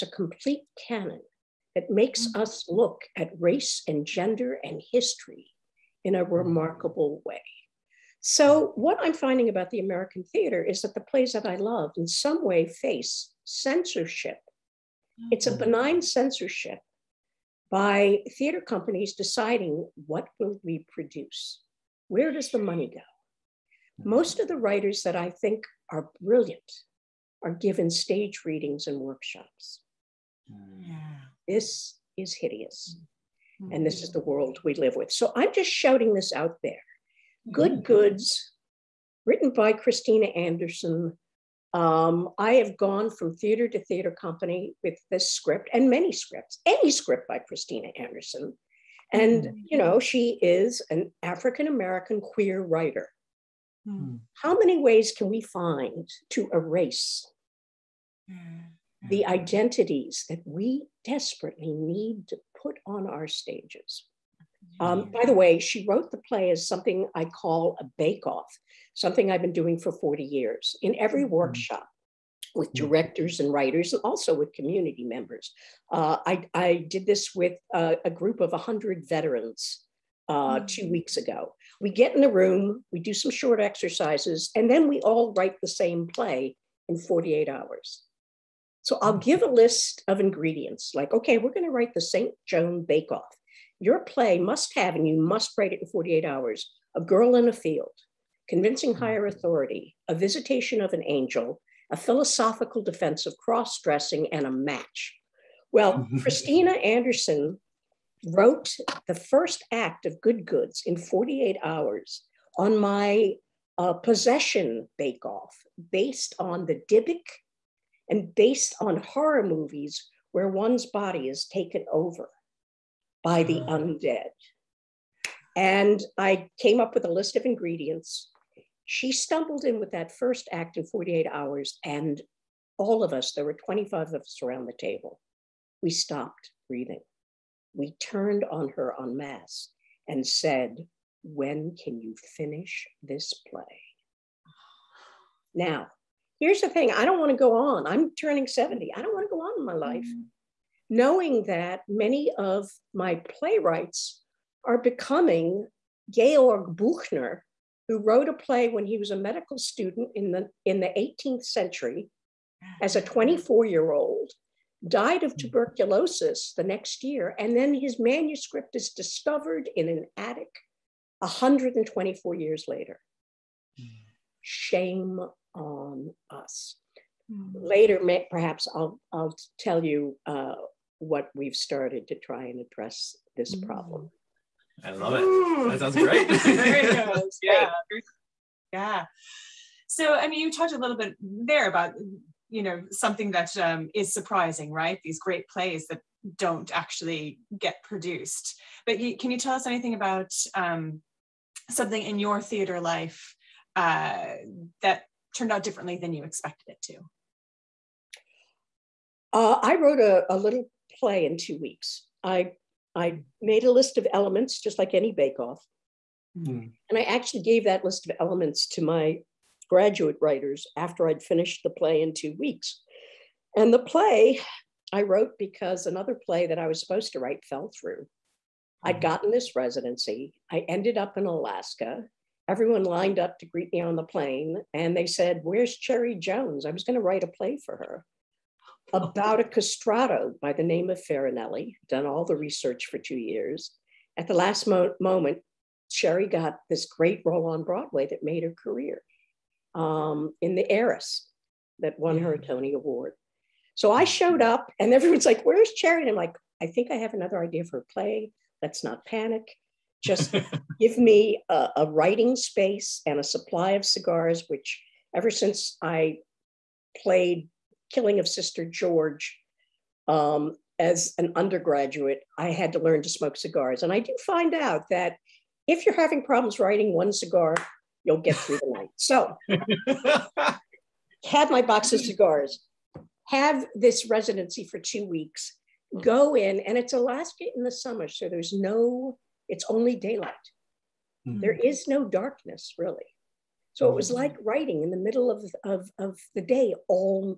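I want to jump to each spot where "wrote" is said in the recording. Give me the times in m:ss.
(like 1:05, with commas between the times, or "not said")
1:05, 1:48, 2:37, 3:29, 3:45.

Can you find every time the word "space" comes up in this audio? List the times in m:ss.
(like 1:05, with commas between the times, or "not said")
4:22.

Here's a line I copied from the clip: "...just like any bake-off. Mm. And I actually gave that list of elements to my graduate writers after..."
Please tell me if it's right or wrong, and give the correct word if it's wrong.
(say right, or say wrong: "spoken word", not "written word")
right.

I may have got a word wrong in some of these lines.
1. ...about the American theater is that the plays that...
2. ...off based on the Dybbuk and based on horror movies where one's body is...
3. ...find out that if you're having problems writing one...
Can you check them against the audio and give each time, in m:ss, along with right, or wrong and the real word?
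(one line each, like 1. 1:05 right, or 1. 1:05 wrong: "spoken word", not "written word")
1. 0:09 right
2. 1:55 right
3. 4:34 right.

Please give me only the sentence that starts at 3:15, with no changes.
These great plays that don't actually get produced.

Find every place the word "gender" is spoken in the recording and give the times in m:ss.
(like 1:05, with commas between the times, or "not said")
0:04.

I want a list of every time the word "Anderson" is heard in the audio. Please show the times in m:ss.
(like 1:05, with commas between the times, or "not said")
0:40, 0:47, 1:46.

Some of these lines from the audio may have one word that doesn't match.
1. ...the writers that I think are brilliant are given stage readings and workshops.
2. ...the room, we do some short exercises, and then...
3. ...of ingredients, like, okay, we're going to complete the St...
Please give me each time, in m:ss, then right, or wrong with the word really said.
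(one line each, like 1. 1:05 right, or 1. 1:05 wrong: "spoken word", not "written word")
1. 0:24 right
2. 1:22 right
3. 1:30 wrong: "write", not "complete".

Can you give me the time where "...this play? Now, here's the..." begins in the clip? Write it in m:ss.
2:23.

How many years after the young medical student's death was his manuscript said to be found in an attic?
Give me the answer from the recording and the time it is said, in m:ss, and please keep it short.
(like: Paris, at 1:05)
124 years, at 2:51.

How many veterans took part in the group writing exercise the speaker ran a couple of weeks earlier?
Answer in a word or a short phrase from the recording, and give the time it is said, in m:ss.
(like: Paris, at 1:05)
100, at 1:18.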